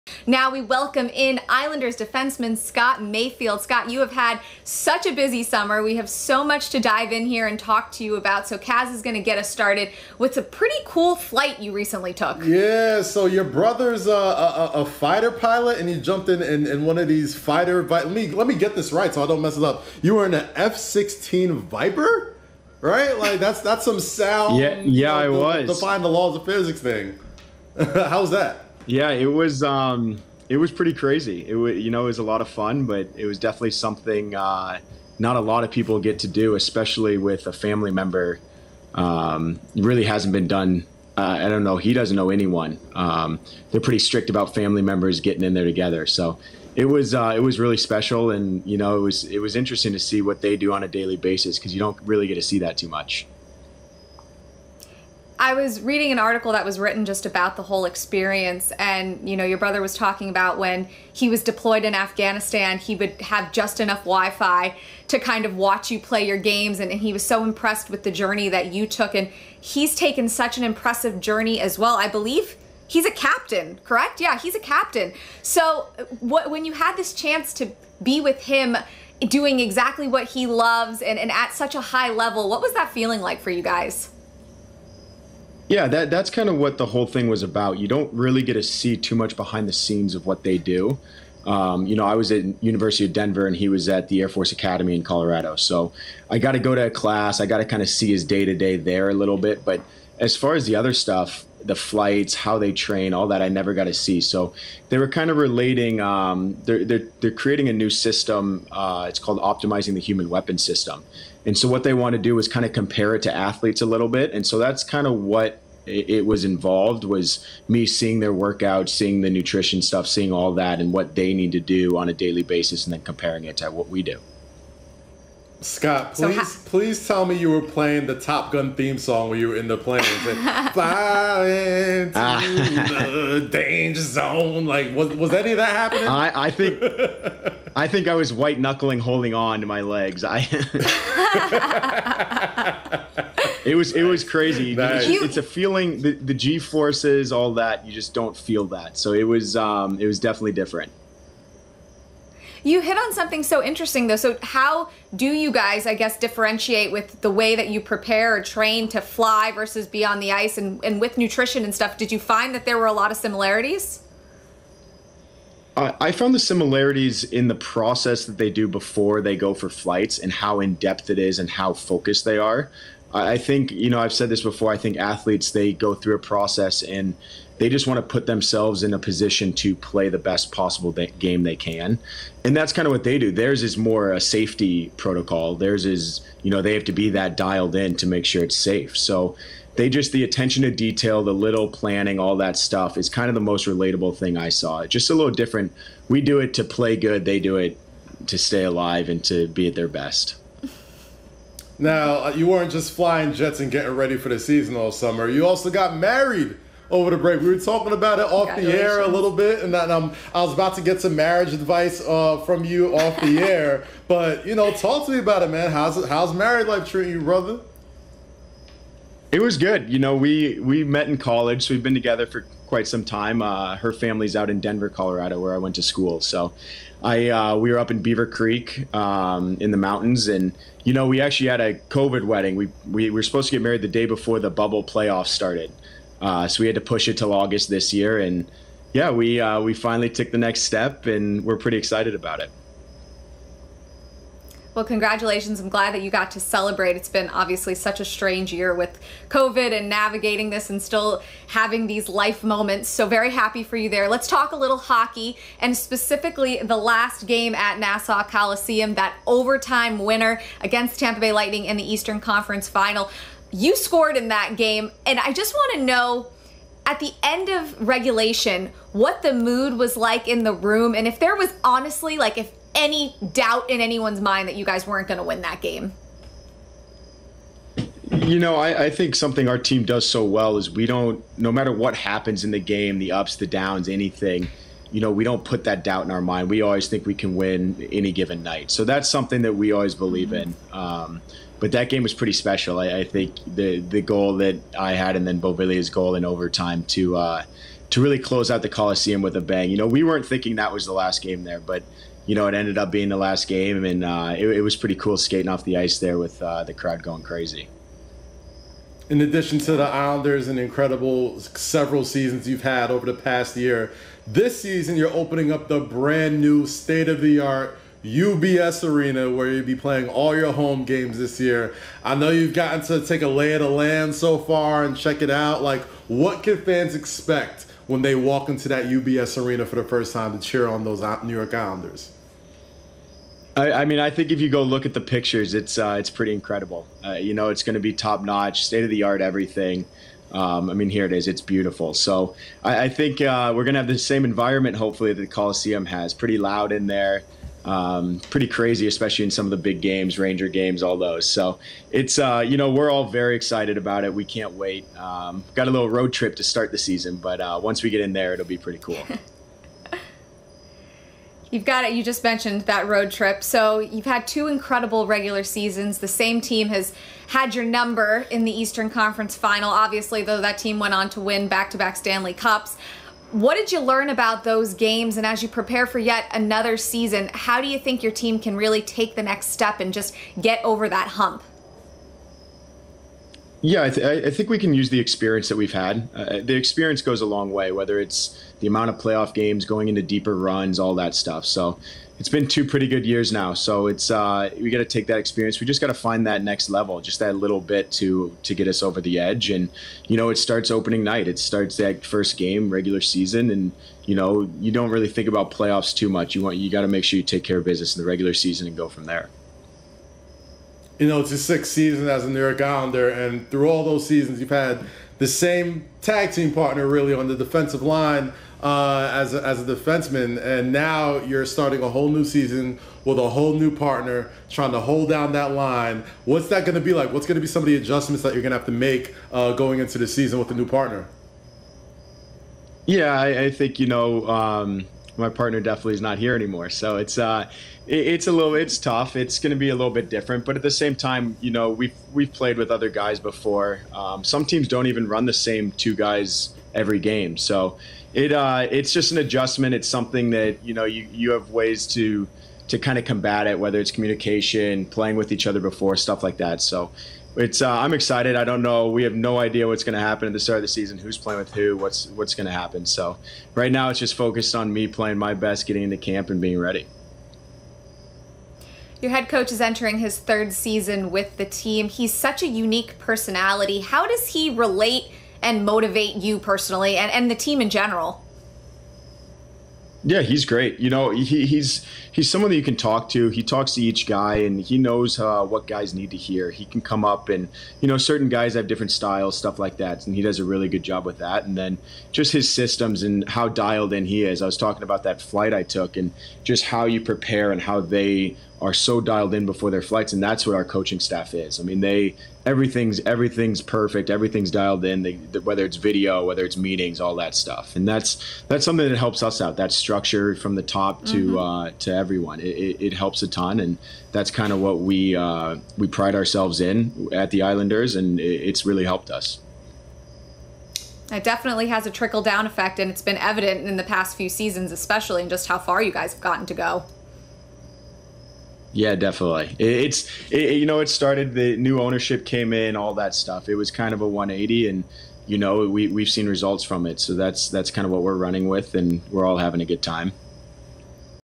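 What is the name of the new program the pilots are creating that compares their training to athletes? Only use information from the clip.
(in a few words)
Optimizing the human weapon system.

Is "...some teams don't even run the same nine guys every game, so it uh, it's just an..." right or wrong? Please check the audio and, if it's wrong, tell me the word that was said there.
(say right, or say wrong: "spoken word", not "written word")
wrong: "two", not "nine".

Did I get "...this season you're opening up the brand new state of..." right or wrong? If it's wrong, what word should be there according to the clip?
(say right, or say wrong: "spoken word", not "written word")
right.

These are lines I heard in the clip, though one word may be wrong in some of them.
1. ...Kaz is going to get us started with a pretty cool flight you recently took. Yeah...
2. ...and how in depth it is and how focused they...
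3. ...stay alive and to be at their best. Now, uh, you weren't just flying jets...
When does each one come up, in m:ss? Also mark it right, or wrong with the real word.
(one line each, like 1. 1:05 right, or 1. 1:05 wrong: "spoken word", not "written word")
1. 0:08 right
2. 2:50 right
3. 3:18 right.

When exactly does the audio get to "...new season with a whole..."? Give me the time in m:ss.
7:02.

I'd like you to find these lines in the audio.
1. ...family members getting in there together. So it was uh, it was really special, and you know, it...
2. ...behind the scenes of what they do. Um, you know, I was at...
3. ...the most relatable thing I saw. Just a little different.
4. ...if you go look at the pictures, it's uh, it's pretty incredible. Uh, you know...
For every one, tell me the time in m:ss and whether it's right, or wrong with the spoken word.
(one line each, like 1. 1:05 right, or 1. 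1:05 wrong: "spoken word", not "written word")
1. 0:44 right
2. 1:29 right
3. 3:13 right
4. 5:34 right.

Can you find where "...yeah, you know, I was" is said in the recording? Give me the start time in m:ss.
0:24.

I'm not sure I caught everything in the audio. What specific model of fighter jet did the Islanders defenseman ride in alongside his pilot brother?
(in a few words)
F-16 Viper.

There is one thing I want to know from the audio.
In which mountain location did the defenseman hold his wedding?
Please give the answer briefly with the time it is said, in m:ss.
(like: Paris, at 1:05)
Beaver Creek, at 3:48.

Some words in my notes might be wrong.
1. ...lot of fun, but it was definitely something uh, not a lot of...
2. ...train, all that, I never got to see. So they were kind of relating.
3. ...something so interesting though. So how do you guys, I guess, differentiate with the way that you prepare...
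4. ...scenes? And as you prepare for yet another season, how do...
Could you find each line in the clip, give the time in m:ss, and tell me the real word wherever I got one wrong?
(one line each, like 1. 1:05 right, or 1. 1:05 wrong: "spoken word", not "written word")
1. 0:32 right
2. 1:42 right
3. 2:33 right
4. 6:14 wrong: "games", not "scenes".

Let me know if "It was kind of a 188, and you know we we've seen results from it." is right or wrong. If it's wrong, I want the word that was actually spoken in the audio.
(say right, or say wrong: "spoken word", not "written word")
wrong: "180", not "188".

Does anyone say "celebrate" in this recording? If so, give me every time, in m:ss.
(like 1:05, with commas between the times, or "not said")
4:06.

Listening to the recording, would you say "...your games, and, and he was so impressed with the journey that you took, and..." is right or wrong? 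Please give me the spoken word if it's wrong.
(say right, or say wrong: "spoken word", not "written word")
right.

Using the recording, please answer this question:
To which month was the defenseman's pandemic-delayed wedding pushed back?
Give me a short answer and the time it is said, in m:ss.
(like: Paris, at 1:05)
August, at 3:57.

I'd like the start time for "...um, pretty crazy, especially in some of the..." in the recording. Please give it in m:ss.
5:47.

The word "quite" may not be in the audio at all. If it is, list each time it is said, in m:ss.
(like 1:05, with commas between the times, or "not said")
3:42.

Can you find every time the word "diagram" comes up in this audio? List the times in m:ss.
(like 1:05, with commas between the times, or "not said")
not said.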